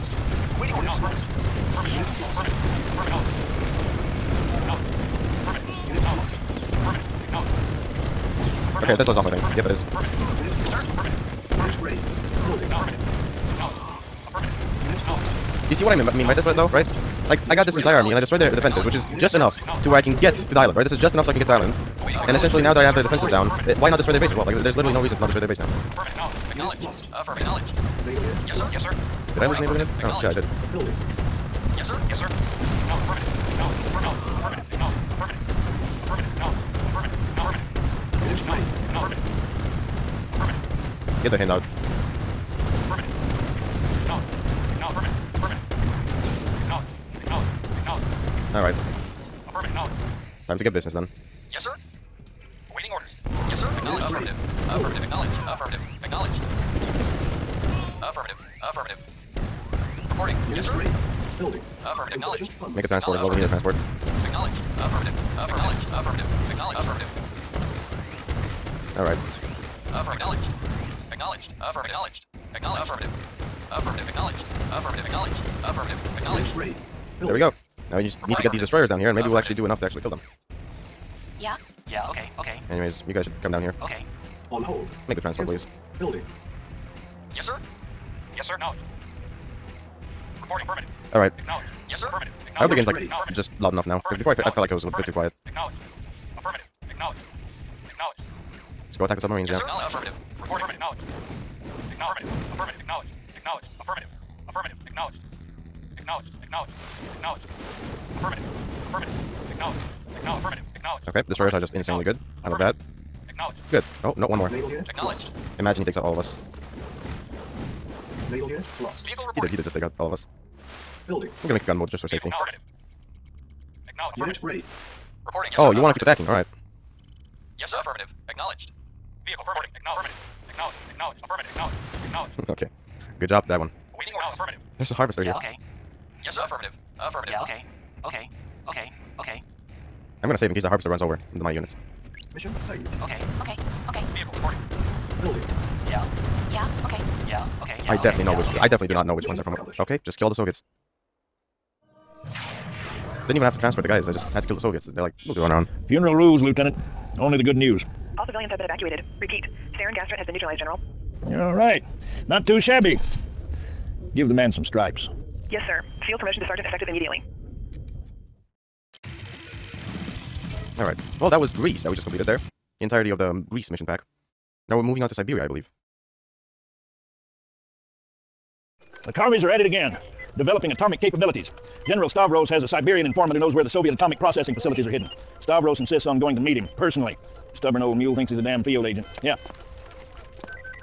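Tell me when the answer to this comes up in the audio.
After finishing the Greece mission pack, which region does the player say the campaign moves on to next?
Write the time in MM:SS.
02:55.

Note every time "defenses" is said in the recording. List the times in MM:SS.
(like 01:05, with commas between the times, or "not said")
00:18, 00:23.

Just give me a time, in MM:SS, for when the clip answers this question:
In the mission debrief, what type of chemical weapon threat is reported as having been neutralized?
02:39.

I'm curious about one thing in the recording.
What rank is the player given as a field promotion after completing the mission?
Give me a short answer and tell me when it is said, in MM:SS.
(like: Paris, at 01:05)
Sergeant, at 02:46.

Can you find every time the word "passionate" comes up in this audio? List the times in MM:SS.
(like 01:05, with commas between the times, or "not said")
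not said.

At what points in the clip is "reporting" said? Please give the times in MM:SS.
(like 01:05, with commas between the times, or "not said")
01:00, 01:30, 01:40, 02:05, 02:24.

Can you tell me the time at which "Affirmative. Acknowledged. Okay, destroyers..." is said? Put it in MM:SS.
01:50.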